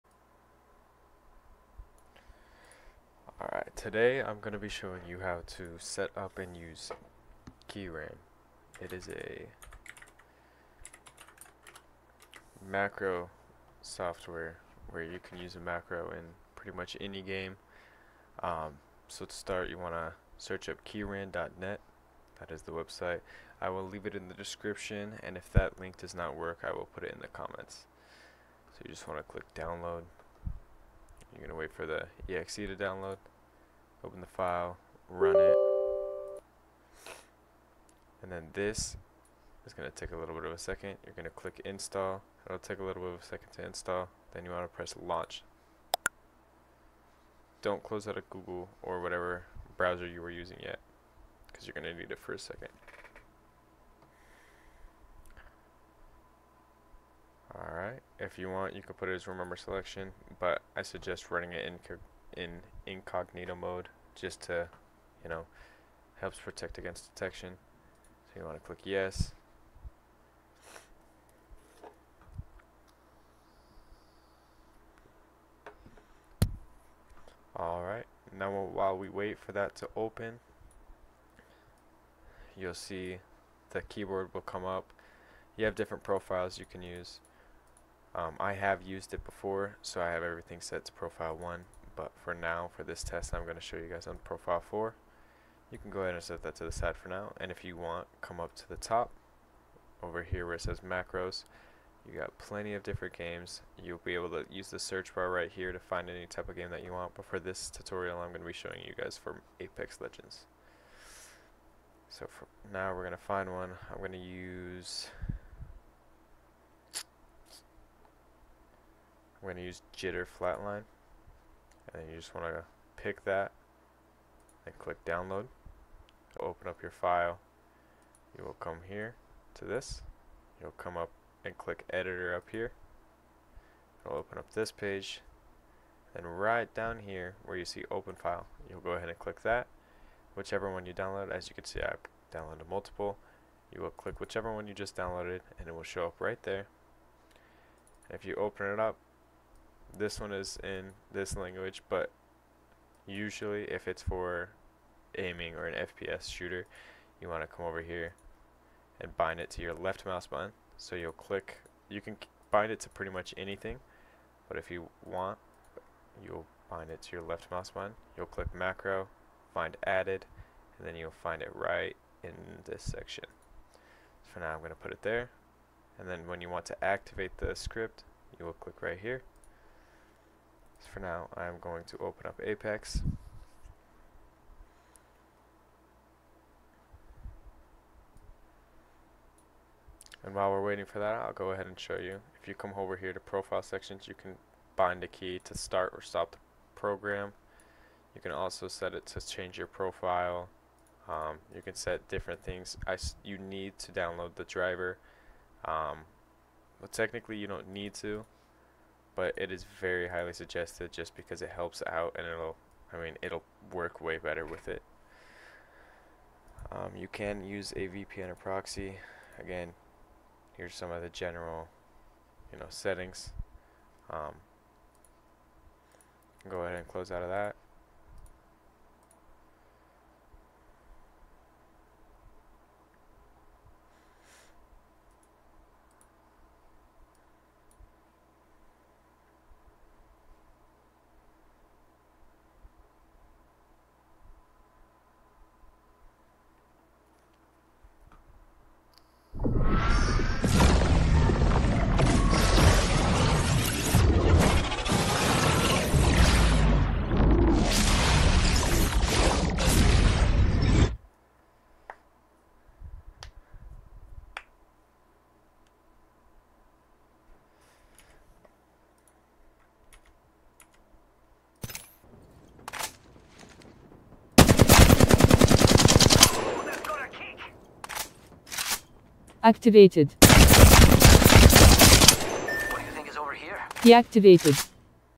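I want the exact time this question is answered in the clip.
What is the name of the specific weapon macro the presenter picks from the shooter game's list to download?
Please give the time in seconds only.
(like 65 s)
119 s.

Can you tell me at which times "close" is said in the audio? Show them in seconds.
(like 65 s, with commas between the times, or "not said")
47 s, 226 s.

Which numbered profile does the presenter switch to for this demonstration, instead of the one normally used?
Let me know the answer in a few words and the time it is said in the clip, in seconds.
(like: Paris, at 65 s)
profile 4, at 94 s.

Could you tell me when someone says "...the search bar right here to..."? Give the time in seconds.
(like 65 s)
104 s.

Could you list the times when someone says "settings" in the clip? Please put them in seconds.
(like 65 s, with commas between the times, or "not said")
222 s.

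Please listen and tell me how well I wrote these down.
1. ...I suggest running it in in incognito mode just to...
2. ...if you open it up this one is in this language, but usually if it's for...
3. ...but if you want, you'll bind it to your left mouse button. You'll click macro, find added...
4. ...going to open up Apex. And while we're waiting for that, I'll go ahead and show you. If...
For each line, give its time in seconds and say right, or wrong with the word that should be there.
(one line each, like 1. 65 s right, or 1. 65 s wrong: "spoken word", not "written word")
1. 60 s right
2. 148 s right
3. 164 s right
4. 181 s right.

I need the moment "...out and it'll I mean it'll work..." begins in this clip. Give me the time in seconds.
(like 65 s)
211 s.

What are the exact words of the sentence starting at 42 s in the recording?
It'll take a little bit of a second to install.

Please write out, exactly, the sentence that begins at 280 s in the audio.
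What do you think is over here?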